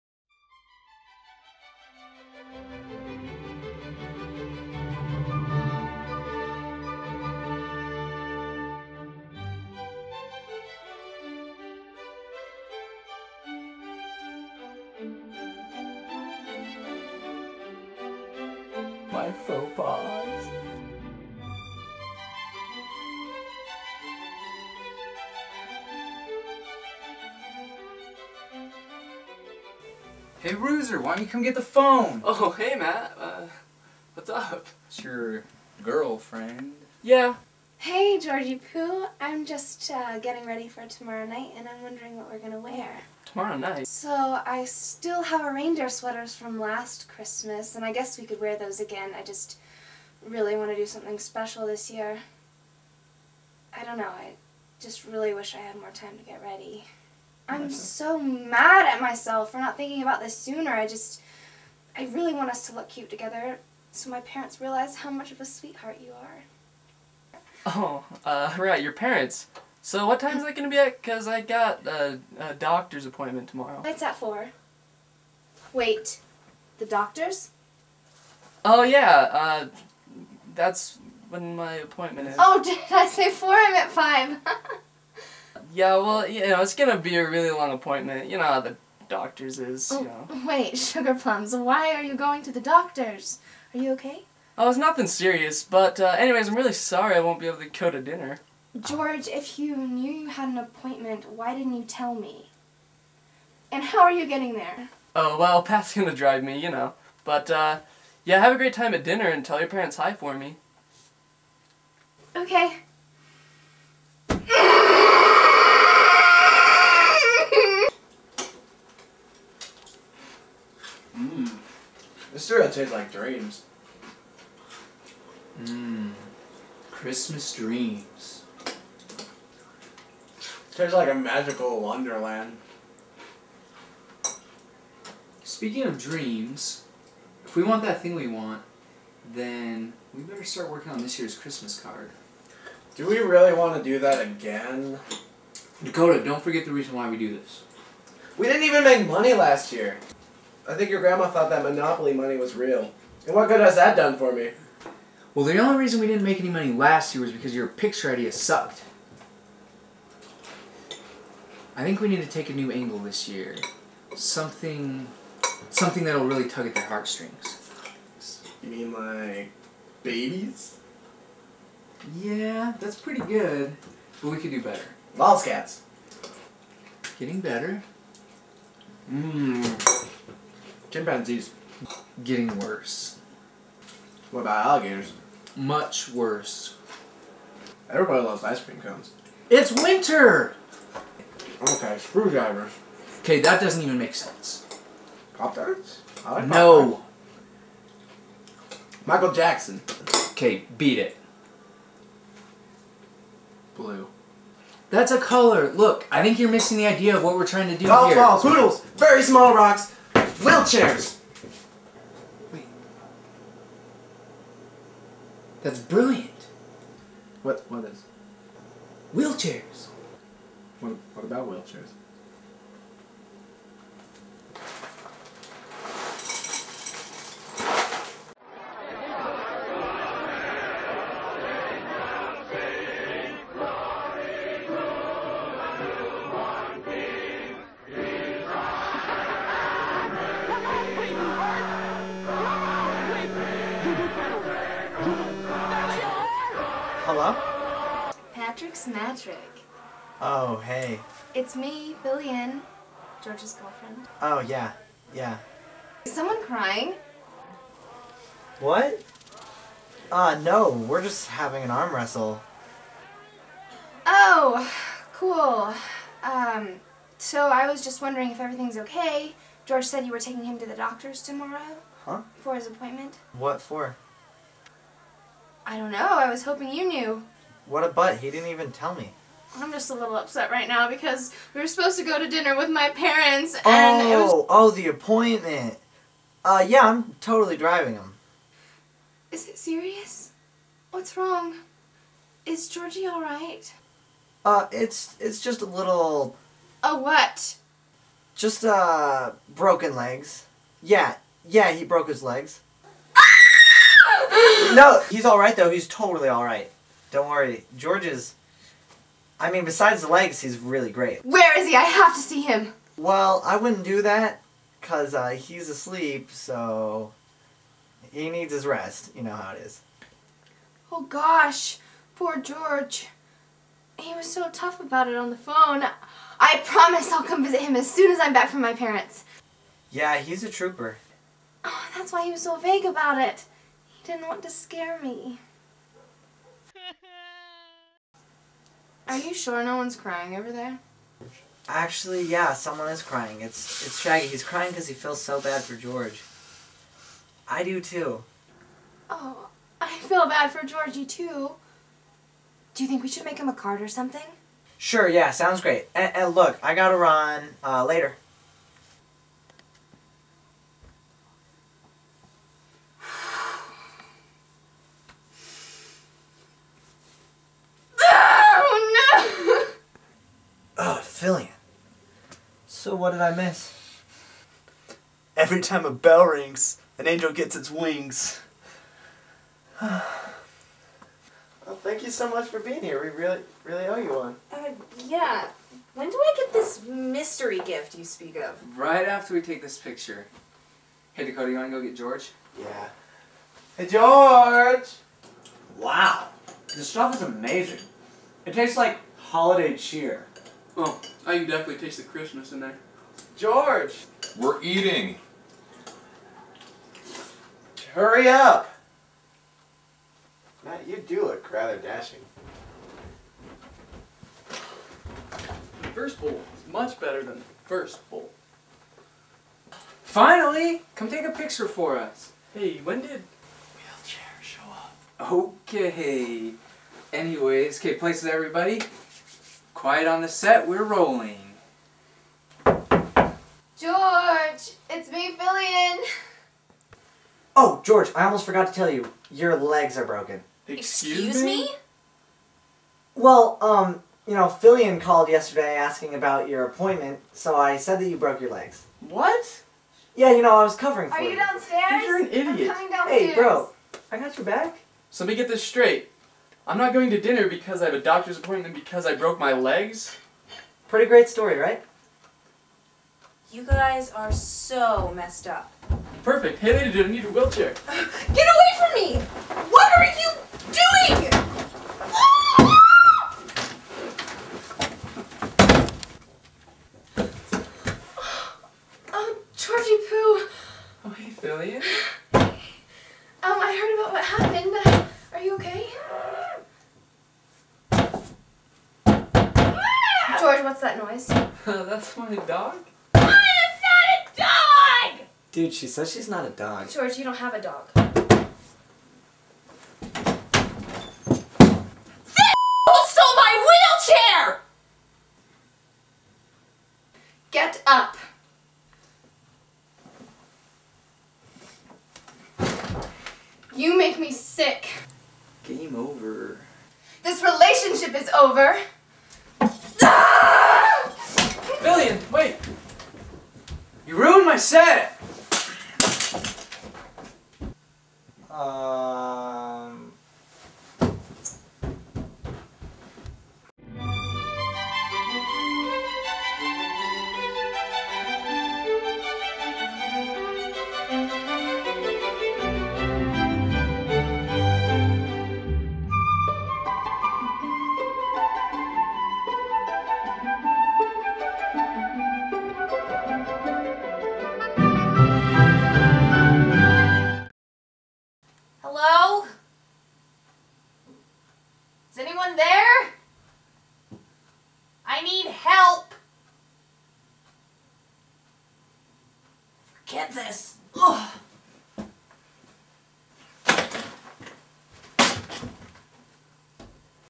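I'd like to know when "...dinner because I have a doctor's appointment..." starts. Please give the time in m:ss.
7:37.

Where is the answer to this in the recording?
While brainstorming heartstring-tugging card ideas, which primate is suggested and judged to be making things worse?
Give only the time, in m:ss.
3:00.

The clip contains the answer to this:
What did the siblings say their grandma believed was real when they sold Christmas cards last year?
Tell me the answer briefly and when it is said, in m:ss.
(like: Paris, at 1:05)
Monopoly money, at 2:31.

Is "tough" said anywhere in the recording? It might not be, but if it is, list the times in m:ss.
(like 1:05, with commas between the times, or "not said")
5:24.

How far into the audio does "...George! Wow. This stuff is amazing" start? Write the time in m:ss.
6:33.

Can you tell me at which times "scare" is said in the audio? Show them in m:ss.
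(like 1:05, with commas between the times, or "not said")
5:34.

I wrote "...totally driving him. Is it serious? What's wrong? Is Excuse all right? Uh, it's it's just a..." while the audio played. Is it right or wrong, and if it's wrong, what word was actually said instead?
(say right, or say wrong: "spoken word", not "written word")
wrong: "Georgie", not "Excuse".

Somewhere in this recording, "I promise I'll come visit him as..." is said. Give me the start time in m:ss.
5:26.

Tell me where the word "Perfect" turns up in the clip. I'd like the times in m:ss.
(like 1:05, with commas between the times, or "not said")
7:46.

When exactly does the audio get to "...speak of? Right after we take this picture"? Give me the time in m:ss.
6:28.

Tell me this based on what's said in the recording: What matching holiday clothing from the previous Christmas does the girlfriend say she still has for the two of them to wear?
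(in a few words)
reindeer sweaters.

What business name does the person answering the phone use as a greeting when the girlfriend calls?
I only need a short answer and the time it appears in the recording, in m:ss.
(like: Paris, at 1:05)
Patrick's Magic, at 4:08.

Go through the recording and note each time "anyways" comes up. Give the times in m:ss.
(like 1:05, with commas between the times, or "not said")
1:36, 7:07.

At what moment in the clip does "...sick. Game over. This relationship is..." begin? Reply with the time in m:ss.
8:34.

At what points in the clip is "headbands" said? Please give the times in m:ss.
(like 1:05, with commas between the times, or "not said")
not said.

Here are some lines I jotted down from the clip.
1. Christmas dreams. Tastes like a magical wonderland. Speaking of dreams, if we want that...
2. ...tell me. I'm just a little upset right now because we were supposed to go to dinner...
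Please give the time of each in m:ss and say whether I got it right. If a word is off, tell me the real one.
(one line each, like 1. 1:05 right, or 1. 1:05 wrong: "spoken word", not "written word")
1. 2:06 right
2. 4:38 right.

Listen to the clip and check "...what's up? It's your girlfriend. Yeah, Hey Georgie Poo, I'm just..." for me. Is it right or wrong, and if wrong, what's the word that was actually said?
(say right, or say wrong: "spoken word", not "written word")
right.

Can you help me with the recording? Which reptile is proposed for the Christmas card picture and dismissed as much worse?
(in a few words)
alligators.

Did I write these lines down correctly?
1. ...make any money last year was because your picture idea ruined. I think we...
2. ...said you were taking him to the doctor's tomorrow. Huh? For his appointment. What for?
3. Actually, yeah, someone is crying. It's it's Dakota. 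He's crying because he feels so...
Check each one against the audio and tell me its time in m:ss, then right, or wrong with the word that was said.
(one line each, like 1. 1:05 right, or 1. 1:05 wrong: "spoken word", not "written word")
1. 2:36 wrong: "sucked", not "ruined"
2. 4:29 right
3. 5:41 wrong: "Shaggy", not "Dakota".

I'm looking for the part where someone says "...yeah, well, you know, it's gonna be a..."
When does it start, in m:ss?
1:25.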